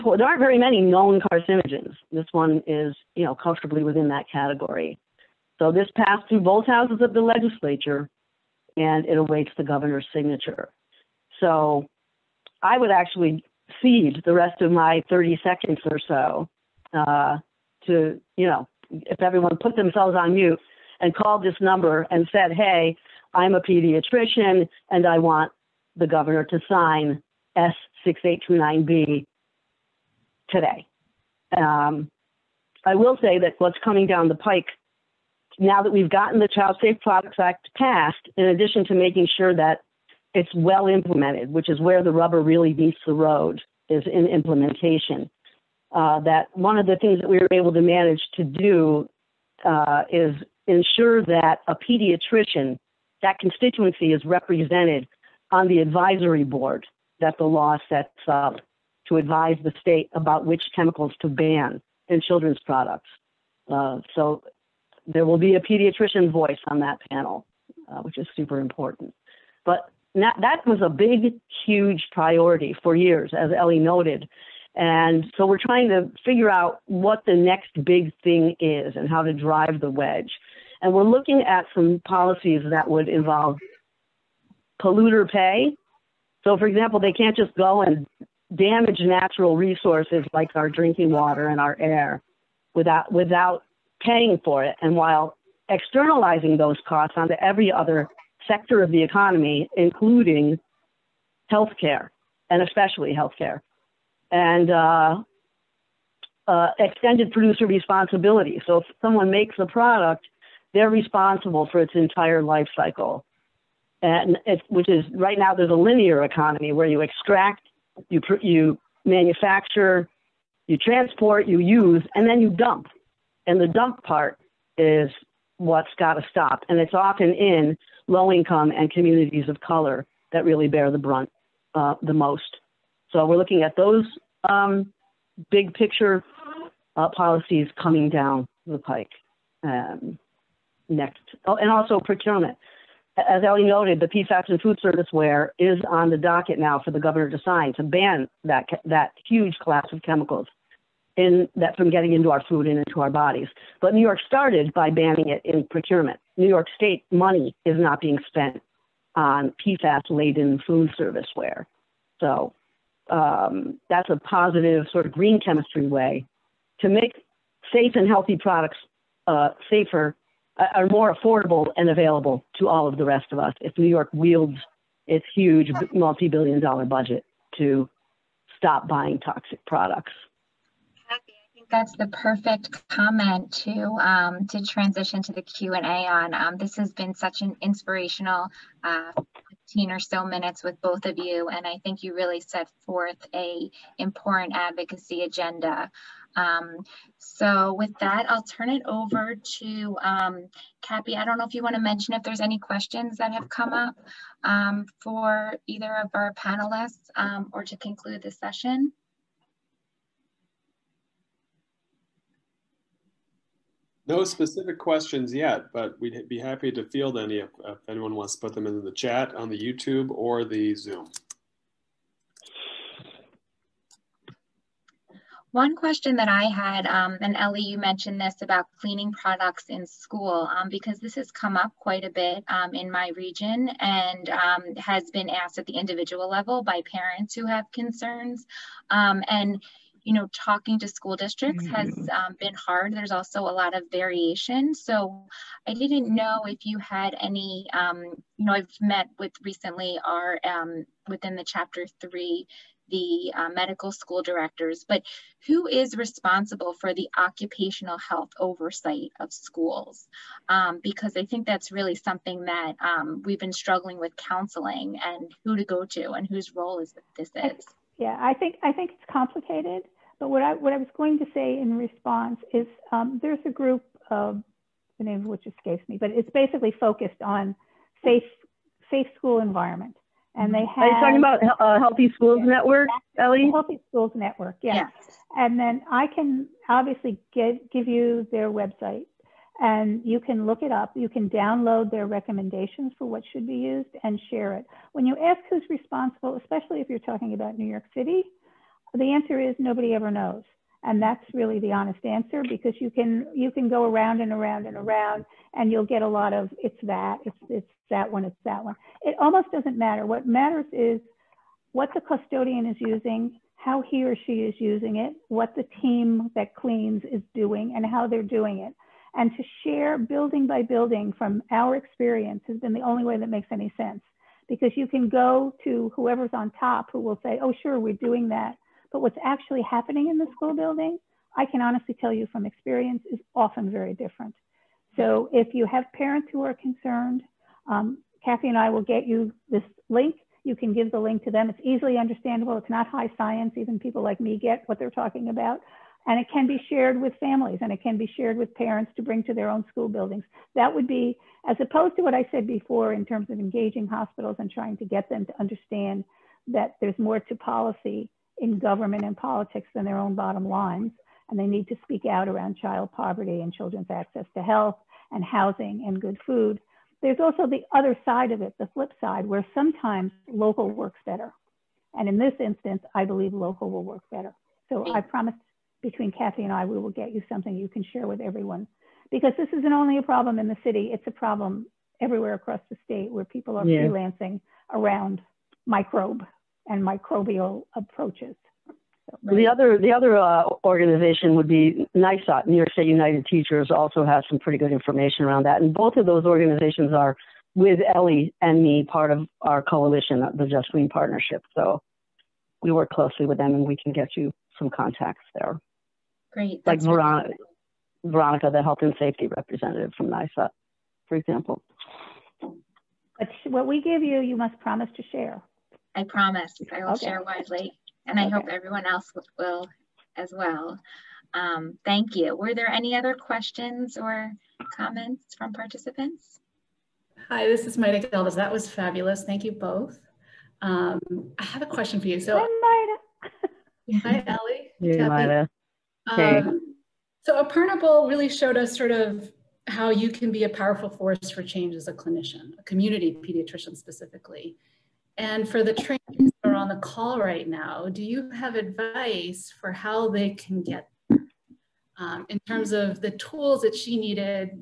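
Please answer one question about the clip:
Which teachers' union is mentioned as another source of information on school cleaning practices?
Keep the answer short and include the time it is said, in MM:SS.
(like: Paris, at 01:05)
New York State United Teachers, at 06:32.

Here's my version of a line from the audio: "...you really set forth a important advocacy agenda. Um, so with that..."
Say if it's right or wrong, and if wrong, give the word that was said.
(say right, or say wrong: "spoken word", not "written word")
right.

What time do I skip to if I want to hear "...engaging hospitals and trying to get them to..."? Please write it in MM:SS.
05:53.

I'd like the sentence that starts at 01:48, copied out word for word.
So if someone makes a product, they're responsible for its entire life cycle.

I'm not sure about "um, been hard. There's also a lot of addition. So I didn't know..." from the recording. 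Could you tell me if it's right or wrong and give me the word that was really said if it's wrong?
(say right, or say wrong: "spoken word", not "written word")
wrong: "variation", not "addition".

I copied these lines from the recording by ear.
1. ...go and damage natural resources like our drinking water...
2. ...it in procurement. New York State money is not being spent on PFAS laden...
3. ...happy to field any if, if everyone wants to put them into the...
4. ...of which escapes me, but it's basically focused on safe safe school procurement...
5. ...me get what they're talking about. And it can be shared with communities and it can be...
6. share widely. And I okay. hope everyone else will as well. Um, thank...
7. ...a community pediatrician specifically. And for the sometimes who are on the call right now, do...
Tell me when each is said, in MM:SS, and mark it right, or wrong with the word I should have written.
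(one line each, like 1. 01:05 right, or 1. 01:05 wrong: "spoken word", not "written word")
1. 01:27 right
2. 02:35 right
3. 03:36 wrong: "anyone", not "everyone"
4. 04:35 wrong: "environment", not "procurement"
5. 05:44 wrong: "families", not "communities"
6. 06:57 right
7. 07:22 wrong: "trainees", not "sometimes".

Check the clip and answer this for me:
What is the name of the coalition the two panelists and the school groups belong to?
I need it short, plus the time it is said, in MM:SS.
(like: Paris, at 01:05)
Just Green Partnership, at 06:40.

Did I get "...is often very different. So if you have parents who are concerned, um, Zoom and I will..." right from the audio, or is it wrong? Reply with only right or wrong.
wrong.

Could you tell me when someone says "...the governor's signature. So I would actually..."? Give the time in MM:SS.
00:09.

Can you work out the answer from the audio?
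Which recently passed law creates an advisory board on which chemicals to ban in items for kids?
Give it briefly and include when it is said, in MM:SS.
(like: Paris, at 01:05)
Child Safe Products Act, at 00:36.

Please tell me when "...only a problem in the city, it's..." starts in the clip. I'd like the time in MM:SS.
06:19.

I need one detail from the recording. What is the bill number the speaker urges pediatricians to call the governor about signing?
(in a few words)
S6829B.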